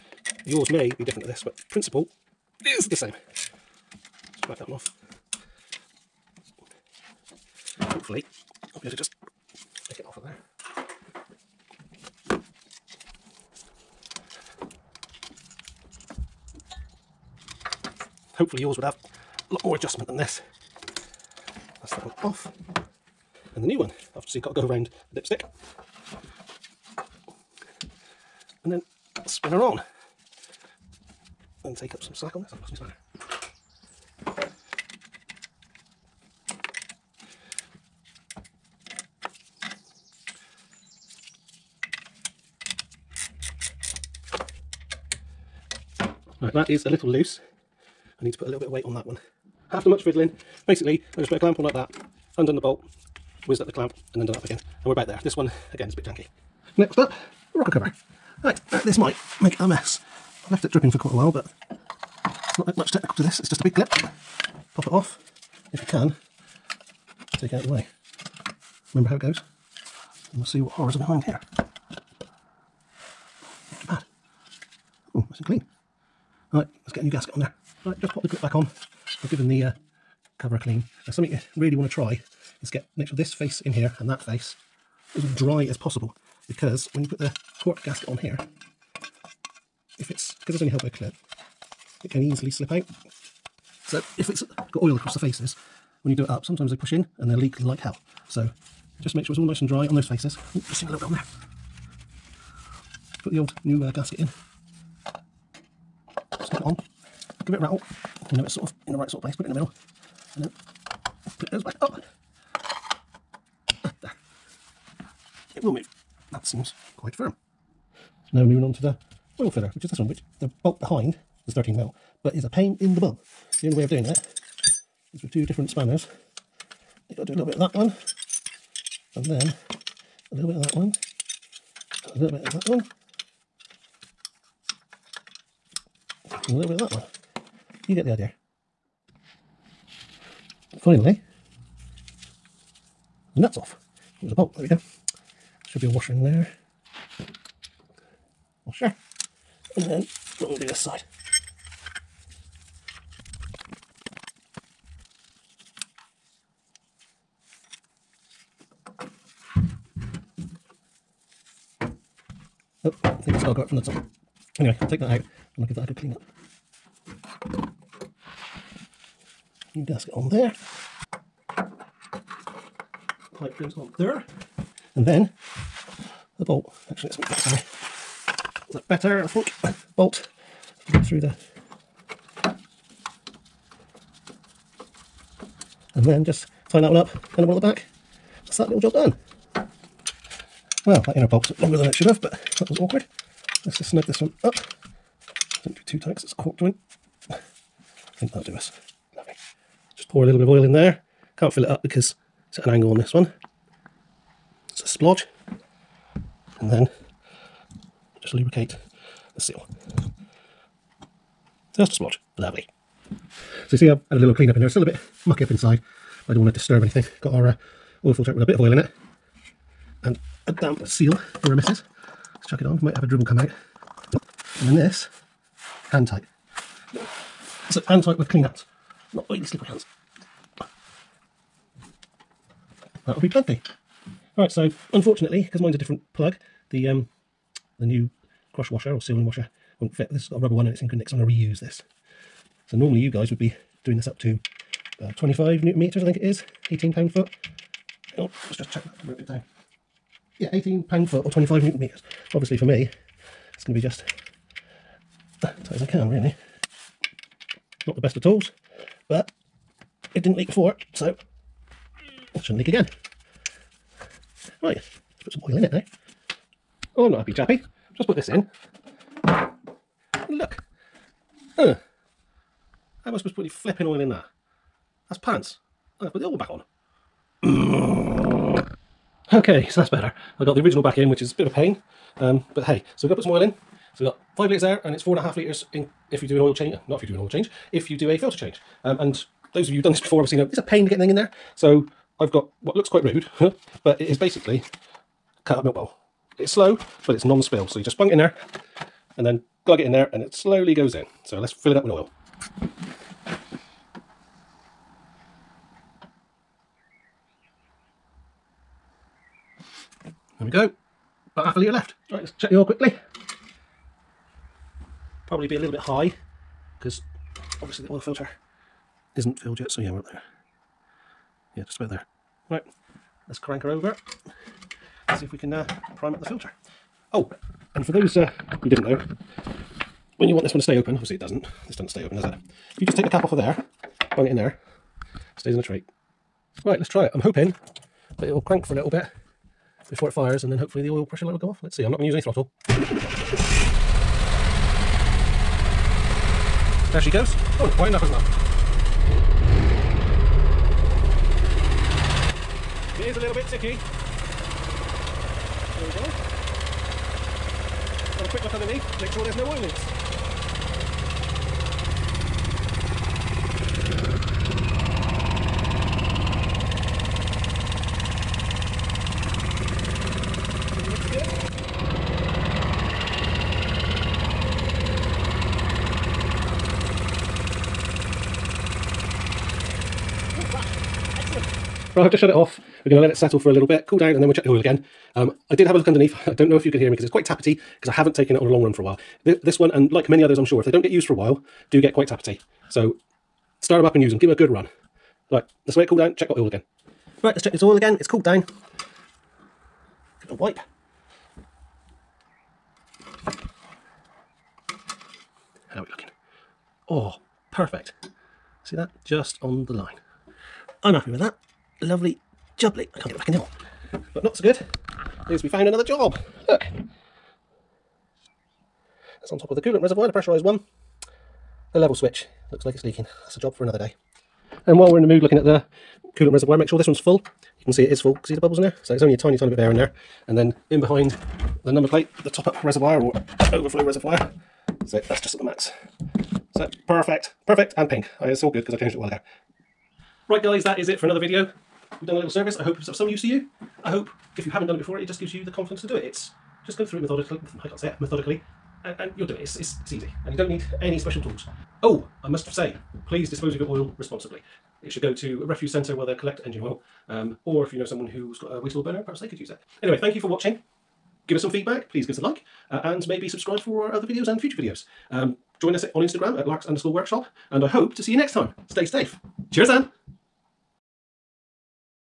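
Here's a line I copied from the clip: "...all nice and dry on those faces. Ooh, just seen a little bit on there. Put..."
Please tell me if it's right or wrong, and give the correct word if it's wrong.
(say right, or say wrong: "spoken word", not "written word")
right.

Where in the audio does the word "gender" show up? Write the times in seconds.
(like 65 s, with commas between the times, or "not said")
not said.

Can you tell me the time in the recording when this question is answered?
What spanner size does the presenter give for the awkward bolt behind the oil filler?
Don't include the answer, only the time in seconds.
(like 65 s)
121 s.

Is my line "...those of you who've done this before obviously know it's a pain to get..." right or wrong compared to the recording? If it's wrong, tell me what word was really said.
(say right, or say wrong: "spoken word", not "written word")
right.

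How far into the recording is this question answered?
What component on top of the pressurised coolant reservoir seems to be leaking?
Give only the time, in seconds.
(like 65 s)
421 s.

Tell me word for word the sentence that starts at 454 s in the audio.
It should go to a refuse centre where they'll collect engine oil.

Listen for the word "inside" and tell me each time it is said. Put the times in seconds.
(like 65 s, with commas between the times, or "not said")
215 s.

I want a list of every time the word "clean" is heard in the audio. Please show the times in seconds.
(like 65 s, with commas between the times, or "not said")
75 s, 80 s, 165 s, 214 s, 228 s.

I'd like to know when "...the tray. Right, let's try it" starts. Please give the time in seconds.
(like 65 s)
335 s.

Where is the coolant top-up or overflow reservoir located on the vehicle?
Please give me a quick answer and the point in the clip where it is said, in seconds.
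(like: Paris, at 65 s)
behind the number plate, at 430 s.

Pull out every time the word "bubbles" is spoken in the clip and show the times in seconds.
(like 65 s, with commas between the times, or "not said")
428 s.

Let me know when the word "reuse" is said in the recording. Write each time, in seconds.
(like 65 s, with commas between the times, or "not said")
241 s.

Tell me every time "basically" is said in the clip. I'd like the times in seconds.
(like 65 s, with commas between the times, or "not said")
50 s, 294 s.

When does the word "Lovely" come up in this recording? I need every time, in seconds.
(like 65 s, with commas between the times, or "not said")
199 s, 212 s, 411 s.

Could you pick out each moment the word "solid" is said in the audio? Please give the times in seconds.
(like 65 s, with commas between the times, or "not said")
not said.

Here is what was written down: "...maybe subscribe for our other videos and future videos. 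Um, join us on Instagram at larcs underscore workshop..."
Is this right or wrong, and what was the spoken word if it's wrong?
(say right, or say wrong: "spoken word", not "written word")
right.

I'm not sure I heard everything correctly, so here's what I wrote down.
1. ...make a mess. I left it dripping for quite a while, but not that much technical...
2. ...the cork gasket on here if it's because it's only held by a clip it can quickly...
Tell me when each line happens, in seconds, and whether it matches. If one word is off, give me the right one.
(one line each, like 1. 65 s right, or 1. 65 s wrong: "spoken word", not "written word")
1. 59 s right
2. 87 s wrong: "easily", not "quickly".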